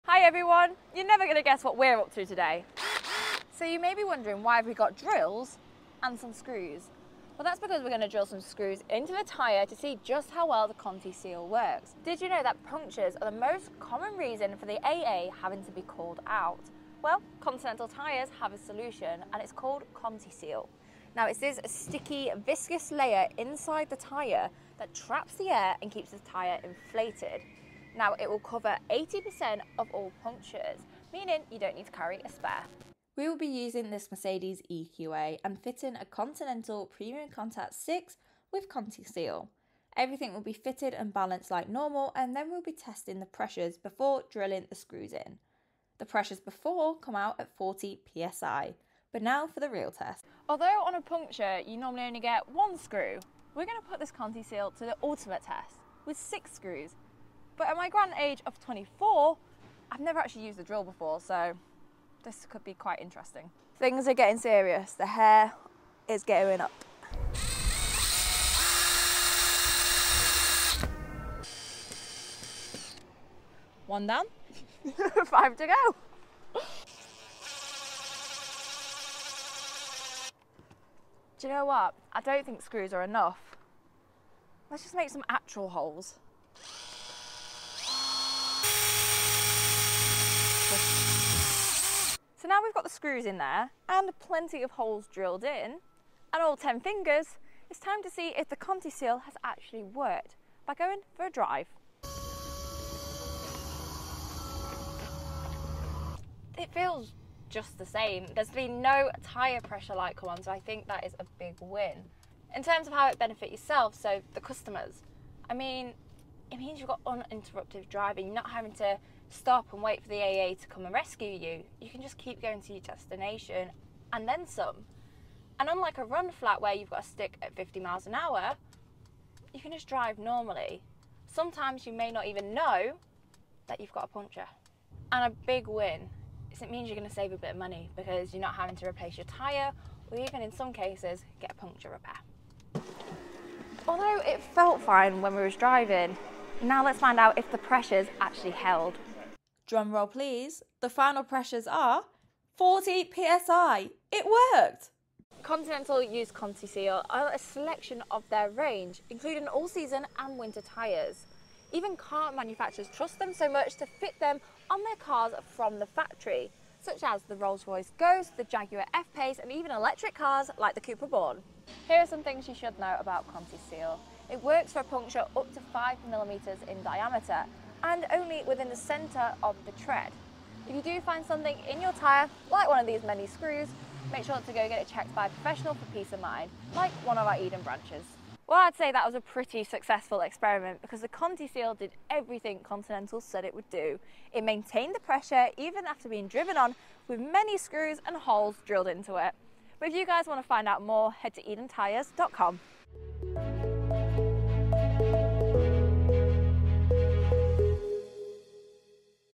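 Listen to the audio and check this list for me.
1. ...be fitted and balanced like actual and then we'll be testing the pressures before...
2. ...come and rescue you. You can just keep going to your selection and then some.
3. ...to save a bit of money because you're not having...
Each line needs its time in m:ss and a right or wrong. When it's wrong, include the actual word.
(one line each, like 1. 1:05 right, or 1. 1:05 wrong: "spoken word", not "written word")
1. 0:40 wrong: "normal", not "actual"
2. 2:00 wrong: "destination", not "selection"
3. 2:17 right.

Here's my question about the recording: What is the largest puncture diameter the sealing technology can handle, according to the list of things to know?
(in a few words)
5 millimetres.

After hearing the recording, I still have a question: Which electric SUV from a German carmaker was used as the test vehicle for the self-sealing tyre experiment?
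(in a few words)
Mercedes EQA.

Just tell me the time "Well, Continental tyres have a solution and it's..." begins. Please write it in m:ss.
0:17.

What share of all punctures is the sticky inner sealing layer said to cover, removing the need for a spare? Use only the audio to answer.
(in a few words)
80%.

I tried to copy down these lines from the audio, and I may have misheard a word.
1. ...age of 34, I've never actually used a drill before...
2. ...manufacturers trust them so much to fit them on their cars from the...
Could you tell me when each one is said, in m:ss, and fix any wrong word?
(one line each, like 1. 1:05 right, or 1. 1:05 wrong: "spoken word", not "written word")
1. 0:58 wrong: "24", not "34"
2. 2:42 right.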